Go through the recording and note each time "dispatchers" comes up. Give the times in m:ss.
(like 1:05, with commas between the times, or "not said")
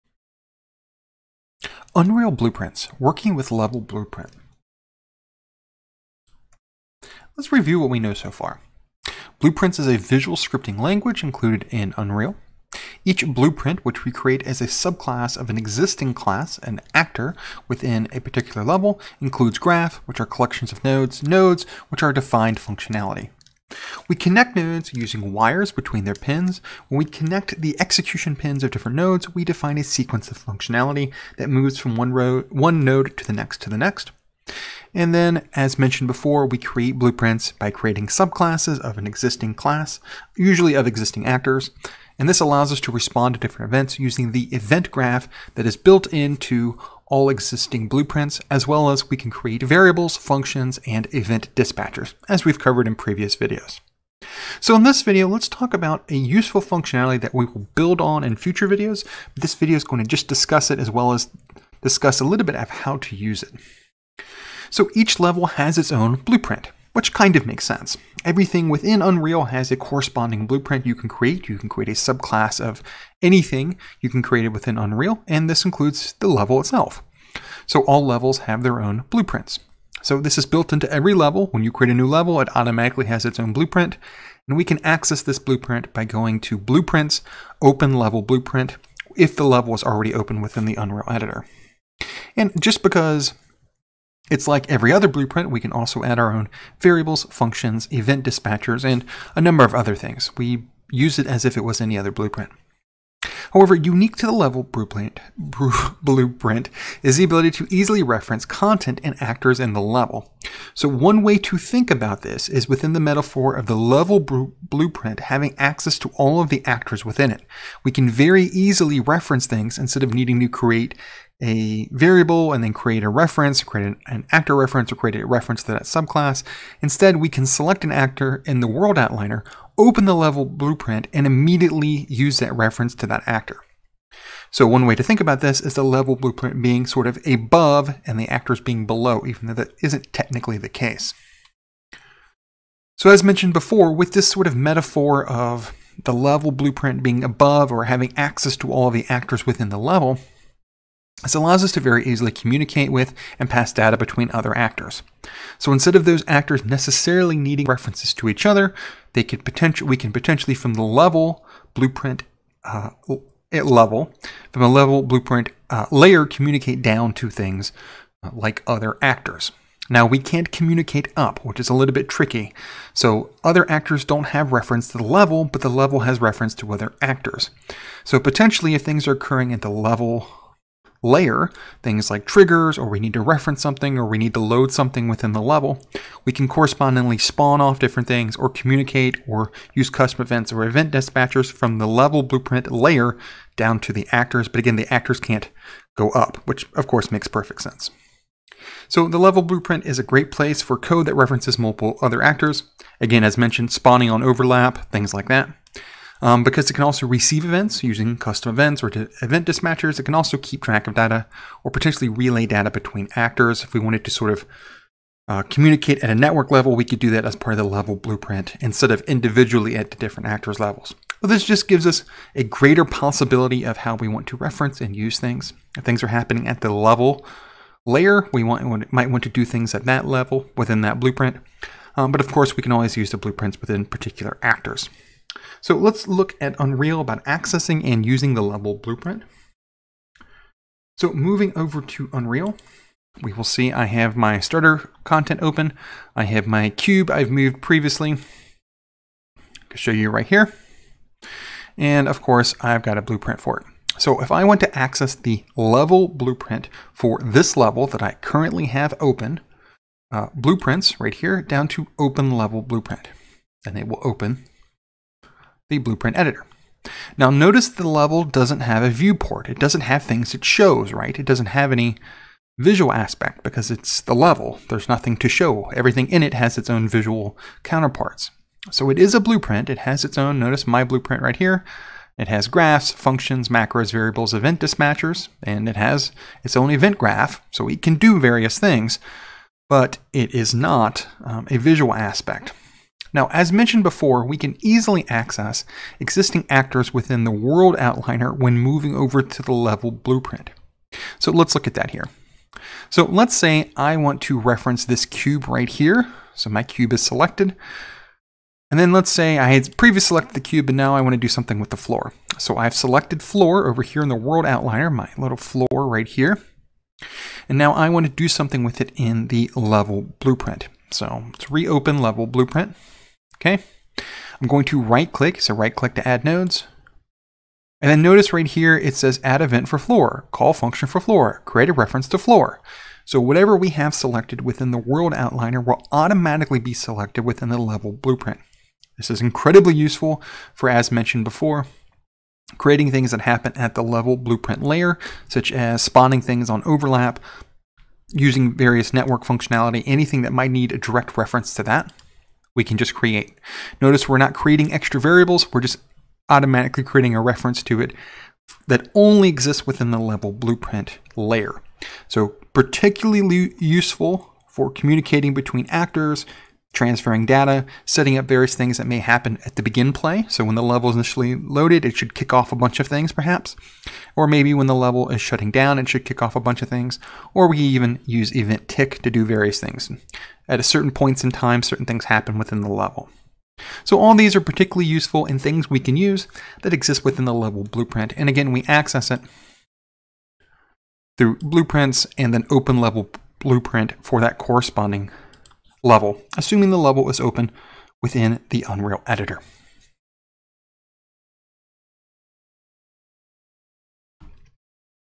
0:51, 1:38, 3:10, 3:29, 4:44.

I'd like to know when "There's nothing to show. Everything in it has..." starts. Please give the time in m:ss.
4:34.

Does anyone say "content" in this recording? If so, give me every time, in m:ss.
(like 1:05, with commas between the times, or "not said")
1:48, 4:05.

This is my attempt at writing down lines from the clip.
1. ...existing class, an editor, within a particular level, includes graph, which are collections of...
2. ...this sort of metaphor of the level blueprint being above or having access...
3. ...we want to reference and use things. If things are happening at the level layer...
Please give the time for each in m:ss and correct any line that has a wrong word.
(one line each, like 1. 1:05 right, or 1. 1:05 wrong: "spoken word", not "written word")
1. 0:15 wrong: "actor", not "editor"
2. 2:24 right
3. 3:43 right.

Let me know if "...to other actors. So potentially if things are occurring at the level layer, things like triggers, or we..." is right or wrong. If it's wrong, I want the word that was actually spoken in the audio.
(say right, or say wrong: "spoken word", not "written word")
right.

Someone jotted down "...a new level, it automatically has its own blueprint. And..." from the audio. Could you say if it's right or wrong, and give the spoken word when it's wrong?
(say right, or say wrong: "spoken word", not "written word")
right.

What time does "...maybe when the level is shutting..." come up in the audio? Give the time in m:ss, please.
6:14.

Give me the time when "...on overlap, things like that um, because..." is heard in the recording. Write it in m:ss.
3:24.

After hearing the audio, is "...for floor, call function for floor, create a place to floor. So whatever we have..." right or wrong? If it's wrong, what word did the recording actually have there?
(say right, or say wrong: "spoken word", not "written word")
wrong: "reference", not "place".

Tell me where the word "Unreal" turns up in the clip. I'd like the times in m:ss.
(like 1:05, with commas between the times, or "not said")
0:01, 0:11, 1:09, 1:14, 1:30, 3:56, 4:02, 6:38.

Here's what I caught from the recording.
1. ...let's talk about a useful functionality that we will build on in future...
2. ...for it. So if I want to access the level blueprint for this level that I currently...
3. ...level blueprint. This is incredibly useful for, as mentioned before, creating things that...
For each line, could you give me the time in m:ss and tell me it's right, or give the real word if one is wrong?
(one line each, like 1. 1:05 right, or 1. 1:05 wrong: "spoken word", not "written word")
1. 0:55 right
2. 4:13 right
3. 5:37 right.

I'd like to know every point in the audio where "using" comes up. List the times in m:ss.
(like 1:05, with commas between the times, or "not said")
0:24, 0:43, 3:27, 3:58, 5:48.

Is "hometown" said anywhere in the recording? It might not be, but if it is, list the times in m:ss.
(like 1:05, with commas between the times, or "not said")
not said.